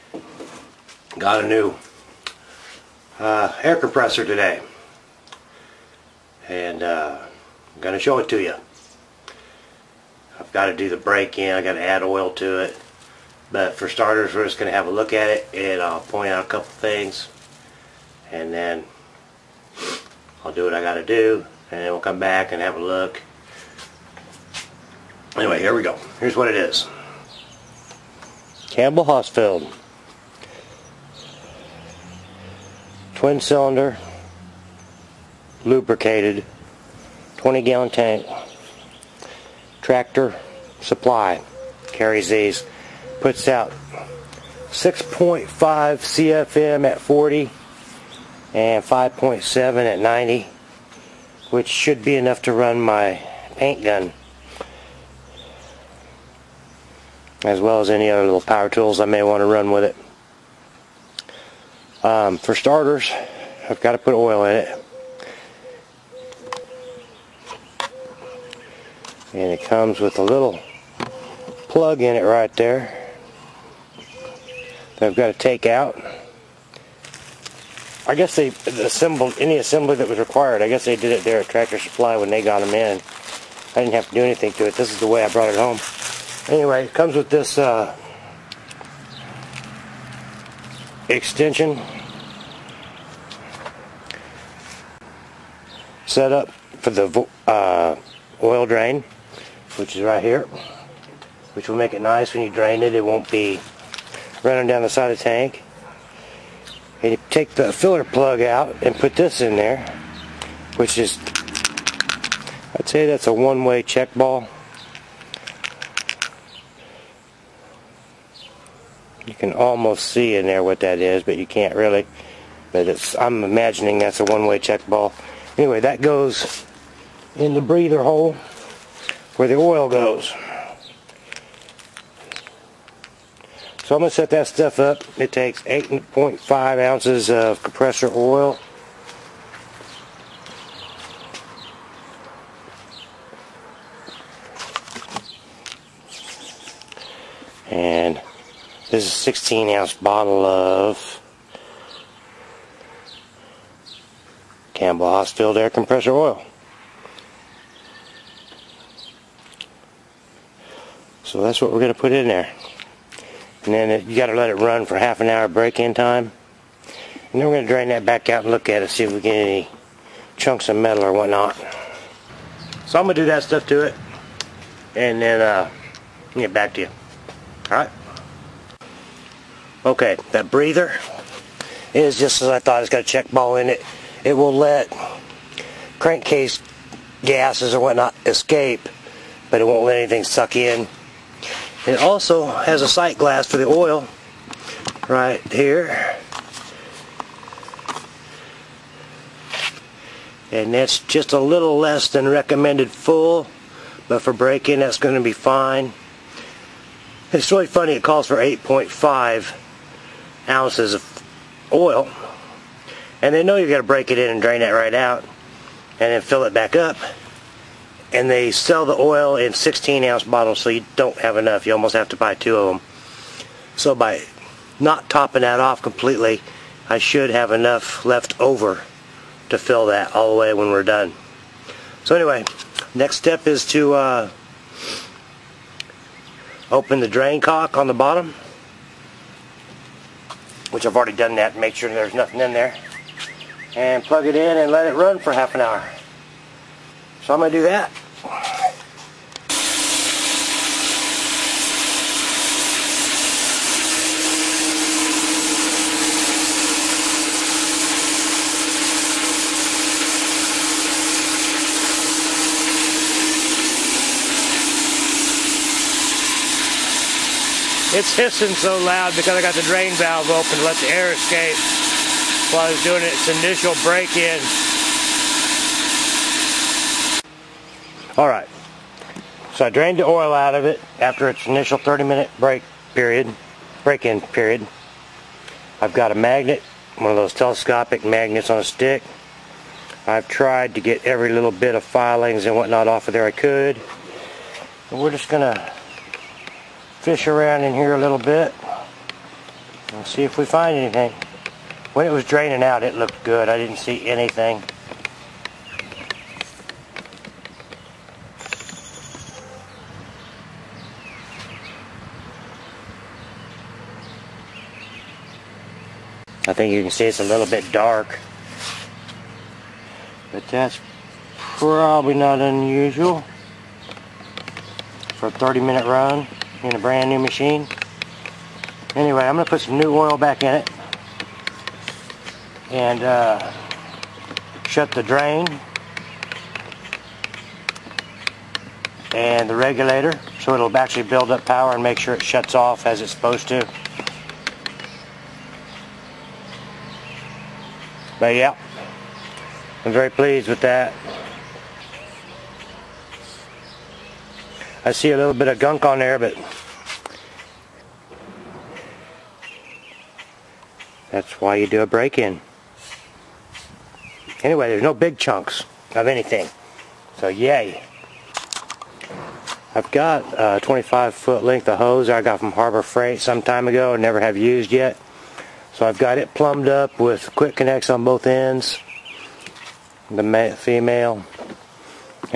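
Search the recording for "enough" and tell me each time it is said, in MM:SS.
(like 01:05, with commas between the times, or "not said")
00:52, 03:41, 03:47.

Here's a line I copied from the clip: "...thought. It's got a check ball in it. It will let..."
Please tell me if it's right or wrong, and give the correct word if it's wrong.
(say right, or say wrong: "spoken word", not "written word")
right.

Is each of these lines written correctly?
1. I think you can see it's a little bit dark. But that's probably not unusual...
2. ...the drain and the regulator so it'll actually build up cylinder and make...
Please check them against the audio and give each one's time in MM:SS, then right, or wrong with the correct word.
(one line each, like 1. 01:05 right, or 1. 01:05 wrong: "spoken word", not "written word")
1. 05:16 right
2. 05:34 wrong: "power", not "cylinder".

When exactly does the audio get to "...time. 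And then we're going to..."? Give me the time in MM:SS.
02:45.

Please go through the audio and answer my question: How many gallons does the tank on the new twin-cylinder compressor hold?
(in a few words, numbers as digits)
20 gallons.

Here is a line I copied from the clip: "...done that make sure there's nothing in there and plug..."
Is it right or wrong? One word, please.
right.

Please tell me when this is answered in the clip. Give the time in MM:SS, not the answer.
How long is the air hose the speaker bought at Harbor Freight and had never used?
06:10.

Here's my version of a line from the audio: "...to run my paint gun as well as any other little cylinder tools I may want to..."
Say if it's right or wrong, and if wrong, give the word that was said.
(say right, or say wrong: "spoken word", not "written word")
wrong: "power", not "cylinder".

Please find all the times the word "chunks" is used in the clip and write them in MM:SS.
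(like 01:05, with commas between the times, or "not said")
02:50, 06:05.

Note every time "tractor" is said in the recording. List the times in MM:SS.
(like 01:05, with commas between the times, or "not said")
00:39, 01:21.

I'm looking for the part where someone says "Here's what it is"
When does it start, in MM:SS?
00:26.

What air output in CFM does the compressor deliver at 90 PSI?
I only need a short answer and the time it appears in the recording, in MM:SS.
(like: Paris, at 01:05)
5.7, at 00:48.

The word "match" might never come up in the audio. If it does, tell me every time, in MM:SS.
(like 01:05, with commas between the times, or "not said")
not said.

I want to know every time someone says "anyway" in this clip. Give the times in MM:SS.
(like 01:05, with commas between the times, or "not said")
00:25, 01:26, 02:05, 03:52, 05:28, 06:04.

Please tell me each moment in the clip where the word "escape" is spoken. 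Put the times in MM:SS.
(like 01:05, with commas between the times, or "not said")
03:08, 04:31.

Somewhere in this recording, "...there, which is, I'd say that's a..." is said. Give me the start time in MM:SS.
01:49.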